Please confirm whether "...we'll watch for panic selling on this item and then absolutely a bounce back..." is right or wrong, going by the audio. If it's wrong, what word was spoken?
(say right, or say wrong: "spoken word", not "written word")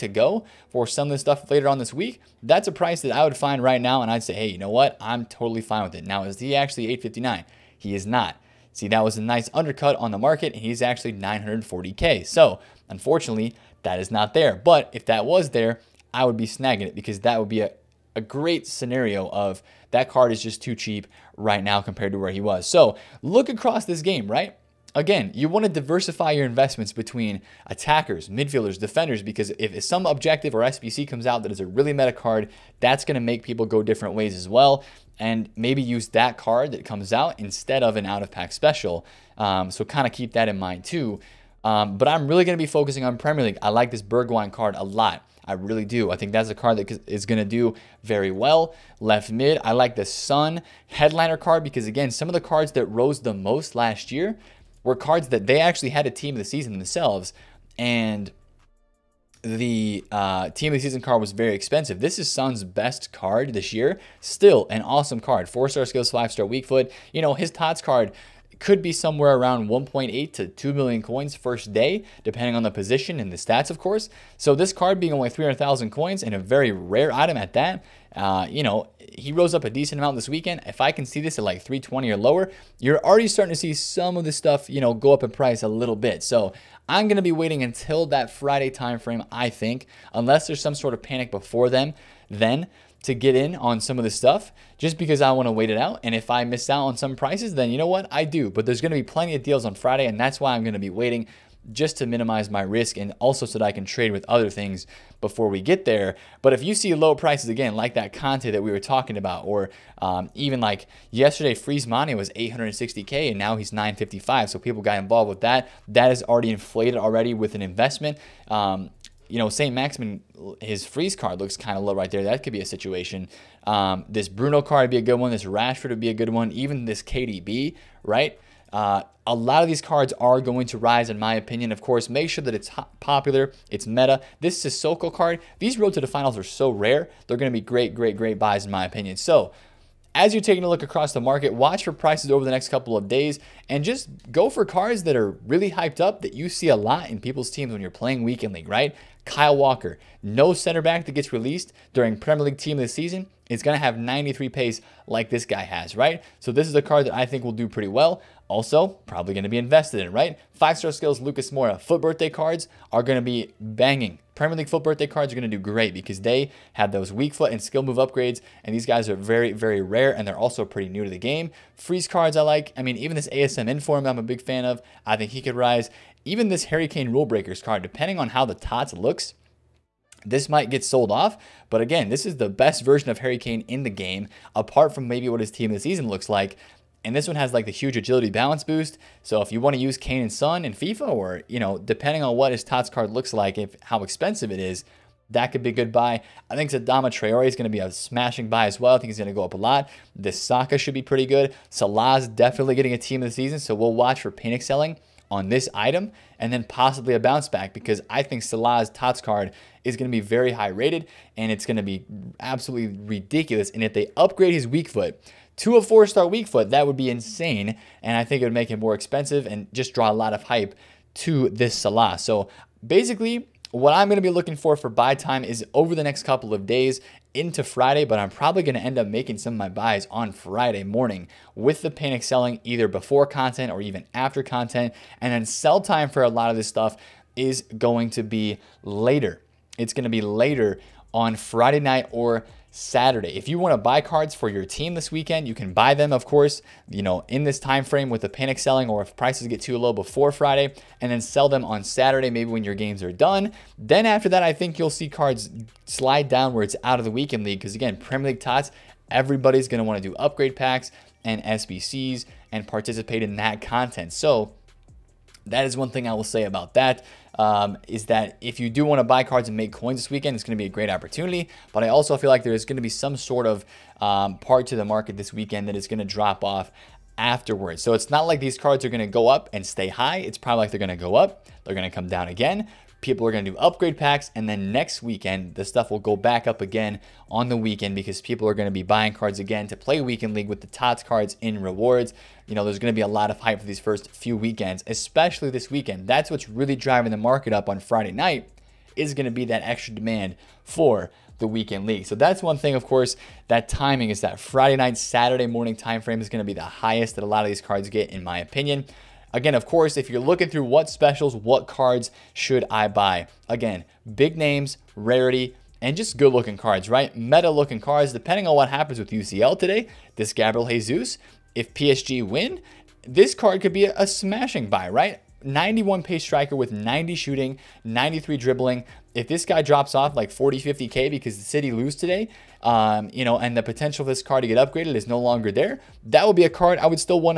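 wrong: "possibly", not "absolutely".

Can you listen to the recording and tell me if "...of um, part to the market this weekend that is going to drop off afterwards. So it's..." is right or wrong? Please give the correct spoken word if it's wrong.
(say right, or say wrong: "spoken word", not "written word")
right.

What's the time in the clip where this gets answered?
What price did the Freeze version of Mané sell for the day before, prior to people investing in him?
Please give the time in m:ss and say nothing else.
1:52.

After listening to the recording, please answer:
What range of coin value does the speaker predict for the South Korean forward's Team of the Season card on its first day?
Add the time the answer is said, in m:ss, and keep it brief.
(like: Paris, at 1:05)
1.8 to 2 million coins, at 1:09.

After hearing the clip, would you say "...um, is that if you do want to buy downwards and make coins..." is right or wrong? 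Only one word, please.
wrong.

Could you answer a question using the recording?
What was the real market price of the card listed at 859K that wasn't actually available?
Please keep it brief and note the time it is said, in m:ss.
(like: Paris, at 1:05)
940K, at 0:11.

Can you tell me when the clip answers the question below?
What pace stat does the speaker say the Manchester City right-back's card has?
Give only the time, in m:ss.
2:33.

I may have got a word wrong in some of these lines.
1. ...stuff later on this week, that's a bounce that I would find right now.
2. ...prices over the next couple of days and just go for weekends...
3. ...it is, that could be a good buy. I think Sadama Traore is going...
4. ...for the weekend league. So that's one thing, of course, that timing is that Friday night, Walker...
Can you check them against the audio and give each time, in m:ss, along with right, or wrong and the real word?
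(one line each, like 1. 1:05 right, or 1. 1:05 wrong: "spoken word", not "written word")
1. 0:01 wrong: "price", not "bounce"
2. 2:21 wrong: "cards", not "weekends"
3. 3:14 right
4. 5:00 wrong: "Saturday", not "Walker".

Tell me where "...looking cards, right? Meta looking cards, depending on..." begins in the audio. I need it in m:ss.
5:16.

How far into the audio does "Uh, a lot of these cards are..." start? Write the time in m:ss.
2:08.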